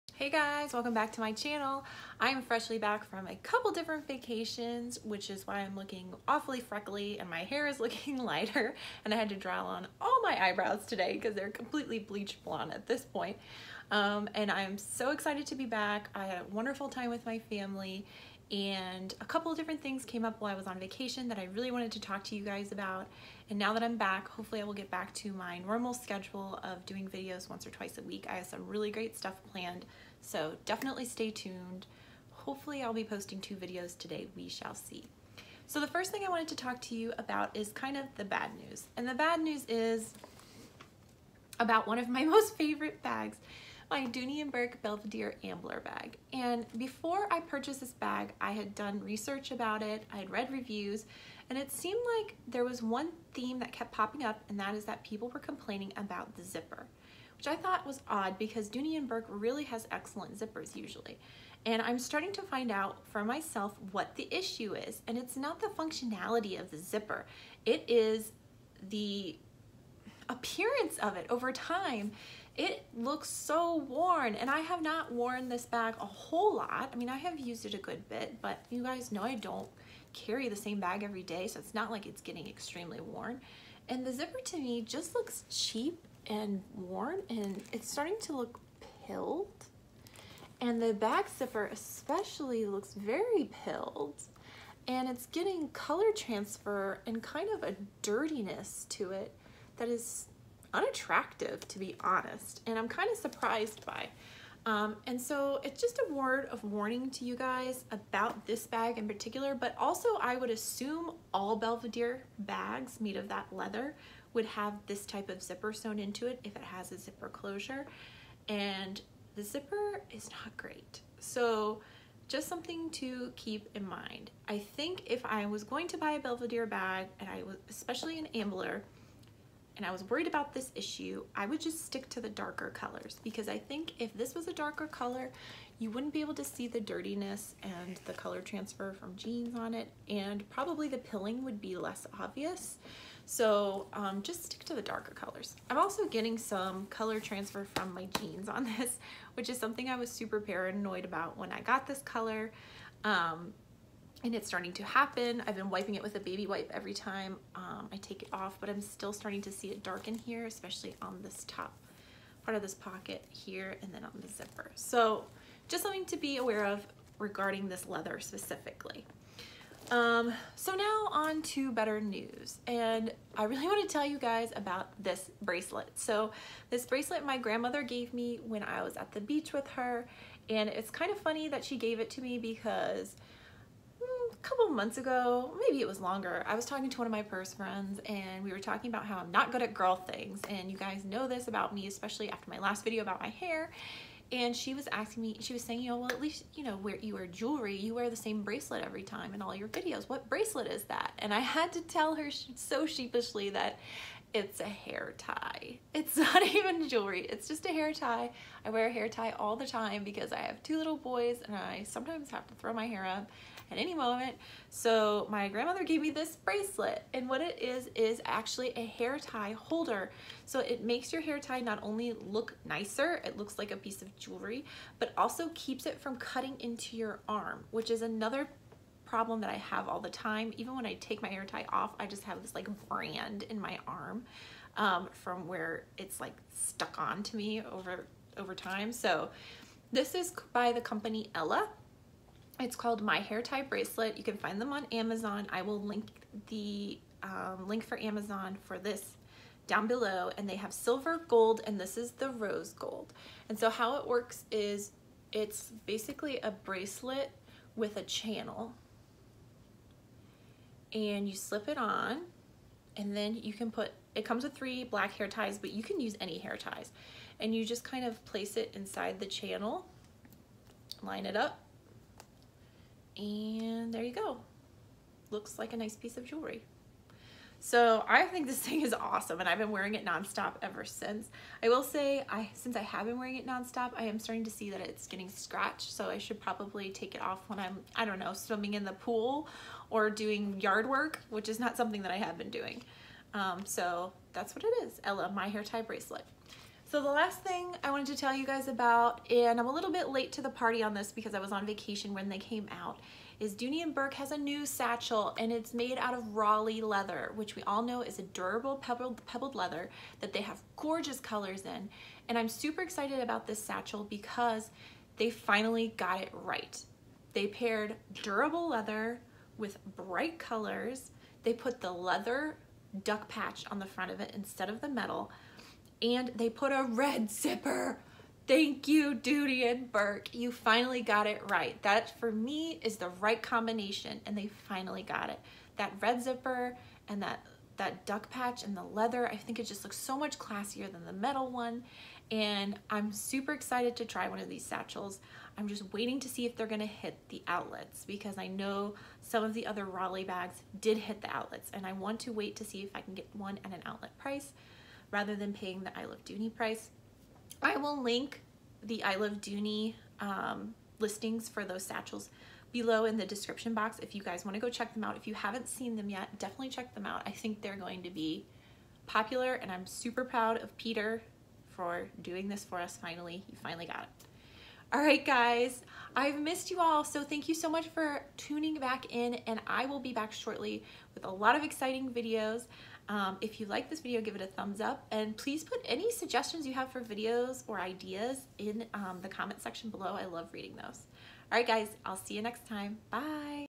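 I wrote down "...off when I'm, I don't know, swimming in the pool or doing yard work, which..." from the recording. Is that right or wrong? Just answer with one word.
right.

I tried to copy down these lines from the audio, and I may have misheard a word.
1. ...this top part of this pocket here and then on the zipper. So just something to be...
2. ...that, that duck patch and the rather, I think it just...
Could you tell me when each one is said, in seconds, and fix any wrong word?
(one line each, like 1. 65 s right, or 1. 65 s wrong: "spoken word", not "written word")
1. 161 s right
2. 337 s wrong: "leather", not "rather".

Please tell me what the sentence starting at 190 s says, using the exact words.
And you guys know this about me, especially after my last video about my hair.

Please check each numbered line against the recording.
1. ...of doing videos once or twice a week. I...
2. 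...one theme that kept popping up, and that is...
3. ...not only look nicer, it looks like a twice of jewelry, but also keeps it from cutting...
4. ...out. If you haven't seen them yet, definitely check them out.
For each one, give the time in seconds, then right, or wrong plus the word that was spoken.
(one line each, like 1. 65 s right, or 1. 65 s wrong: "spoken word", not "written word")
1. 26 s right
2. 52 s right
3. 221 s wrong: "piece", not "twice"
4. 365 s right.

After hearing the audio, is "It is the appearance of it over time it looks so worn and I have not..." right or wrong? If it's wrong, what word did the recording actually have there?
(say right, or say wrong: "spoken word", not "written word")
right.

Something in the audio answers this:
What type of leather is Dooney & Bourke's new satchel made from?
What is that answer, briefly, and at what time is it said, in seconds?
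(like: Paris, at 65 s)
Raleigh leather, at 306 s.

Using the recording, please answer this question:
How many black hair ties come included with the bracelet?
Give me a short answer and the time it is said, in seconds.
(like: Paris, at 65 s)
3, at 264 s.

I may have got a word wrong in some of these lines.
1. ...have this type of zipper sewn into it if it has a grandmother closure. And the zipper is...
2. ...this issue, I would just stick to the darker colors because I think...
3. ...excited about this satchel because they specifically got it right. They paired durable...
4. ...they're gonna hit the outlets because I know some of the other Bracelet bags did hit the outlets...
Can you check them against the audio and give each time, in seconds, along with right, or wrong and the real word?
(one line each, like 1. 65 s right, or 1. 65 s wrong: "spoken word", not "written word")
1. 114 s wrong: "zipper", not "grandmother"
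2. 130 s right
3. 312 s wrong: "finally", not "specifically"
4. 346 s wrong: "Raleigh", not "Bracelet".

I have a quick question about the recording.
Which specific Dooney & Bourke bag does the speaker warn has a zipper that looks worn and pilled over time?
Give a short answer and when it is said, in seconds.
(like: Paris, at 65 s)
Belvedere Ambler, at 44 s.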